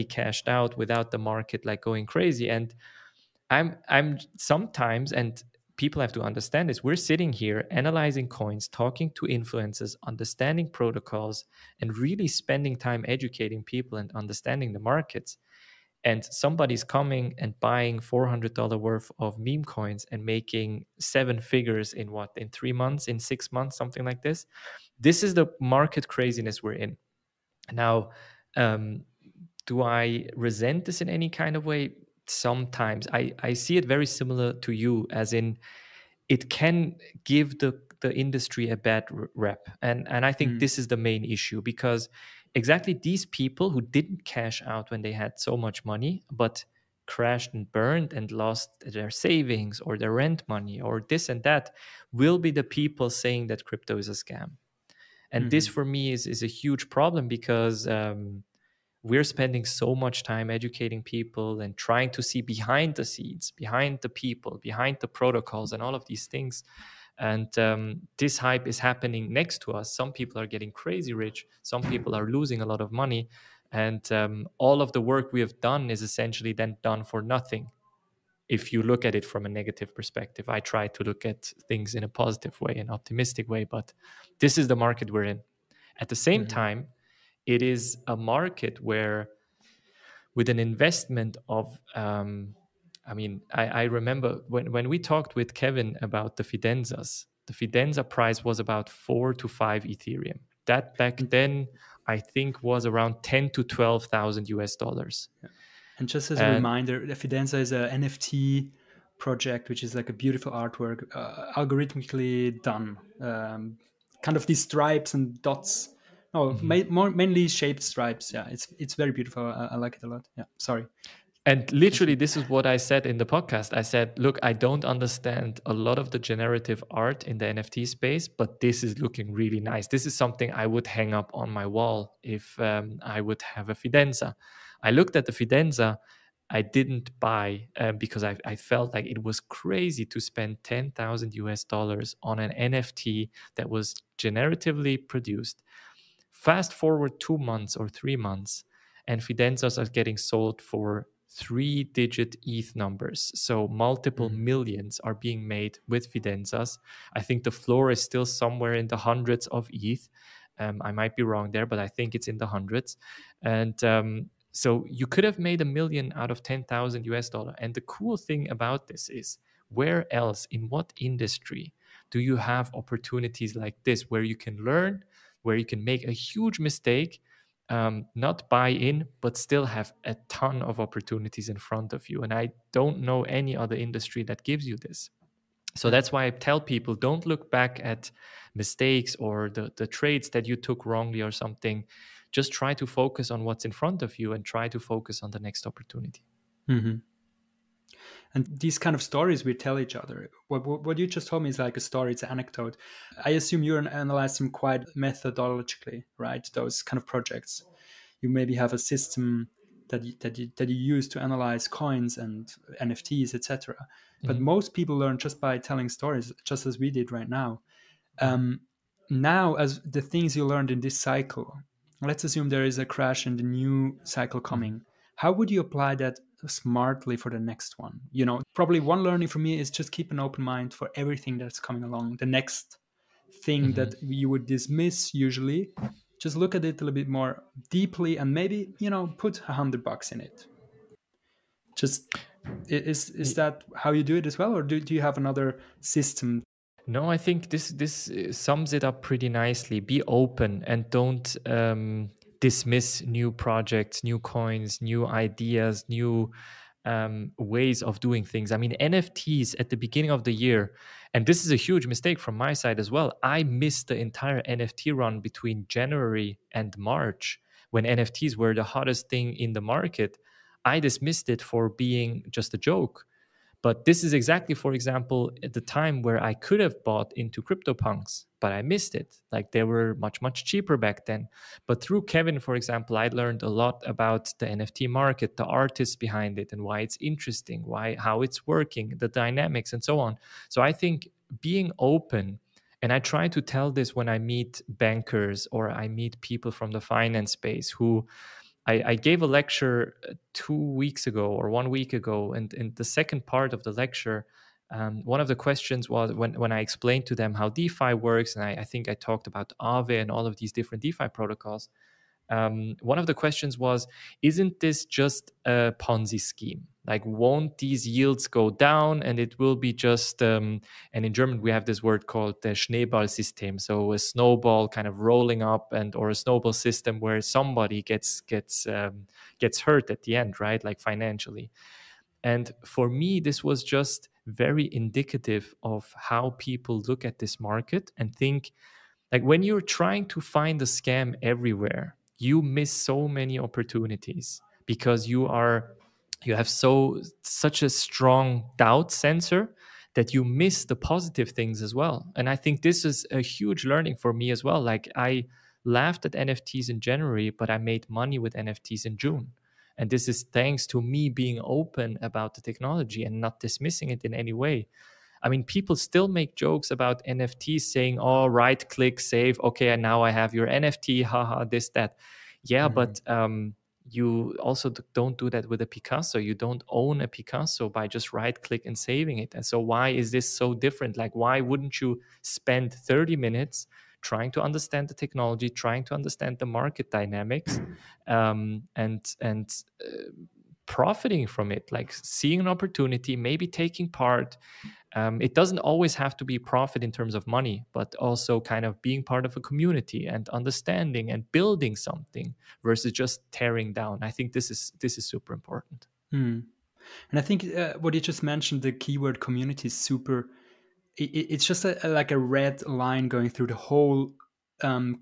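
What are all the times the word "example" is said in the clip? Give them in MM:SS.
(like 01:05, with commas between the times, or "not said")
04:34, 04:42.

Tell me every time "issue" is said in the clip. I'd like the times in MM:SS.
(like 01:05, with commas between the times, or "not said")
00:41.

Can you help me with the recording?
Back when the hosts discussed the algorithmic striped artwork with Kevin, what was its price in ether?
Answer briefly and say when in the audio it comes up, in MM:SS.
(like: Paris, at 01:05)
4 to 5 ETH, at 01:38.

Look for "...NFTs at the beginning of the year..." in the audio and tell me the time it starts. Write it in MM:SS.
04:18.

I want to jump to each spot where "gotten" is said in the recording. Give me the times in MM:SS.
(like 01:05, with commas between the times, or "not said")
not said.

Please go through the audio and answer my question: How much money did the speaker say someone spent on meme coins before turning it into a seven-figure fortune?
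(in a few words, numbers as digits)
$400.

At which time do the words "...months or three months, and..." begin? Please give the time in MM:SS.
02:27.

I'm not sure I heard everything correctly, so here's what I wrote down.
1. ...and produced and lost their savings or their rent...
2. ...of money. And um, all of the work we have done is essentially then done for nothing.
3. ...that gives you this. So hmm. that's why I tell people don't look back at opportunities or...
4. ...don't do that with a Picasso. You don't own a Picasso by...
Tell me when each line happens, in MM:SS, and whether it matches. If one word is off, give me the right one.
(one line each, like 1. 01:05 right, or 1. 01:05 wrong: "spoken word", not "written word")
1. 00:47 wrong: "burned", not "produced"
2. 01:12 right
3. 03:04 wrong: "mistakes", not "opportunities"
4. 06:14 right.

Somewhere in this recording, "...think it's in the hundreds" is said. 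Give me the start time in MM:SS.
02:41.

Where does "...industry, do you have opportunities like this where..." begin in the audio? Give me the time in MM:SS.
02:51.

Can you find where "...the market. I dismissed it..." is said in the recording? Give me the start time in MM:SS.
04:29.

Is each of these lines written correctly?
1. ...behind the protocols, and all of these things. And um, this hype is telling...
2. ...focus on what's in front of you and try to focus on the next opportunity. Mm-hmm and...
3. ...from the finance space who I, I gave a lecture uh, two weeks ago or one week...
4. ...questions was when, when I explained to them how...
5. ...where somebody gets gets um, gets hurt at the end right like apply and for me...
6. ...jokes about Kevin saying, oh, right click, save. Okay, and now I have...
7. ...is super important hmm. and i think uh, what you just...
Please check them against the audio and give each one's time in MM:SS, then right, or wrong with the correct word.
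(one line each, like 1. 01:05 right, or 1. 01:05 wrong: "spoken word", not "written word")
1. 01:04 wrong: "happening", not "telling"
2. 03:12 right
3. 04:56 right
4. 05:05 right
5. 05:26 wrong: "financially", not "apply"
6. 06:06 wrong: "NFTs", not "Kevin"
7. 06:44 right.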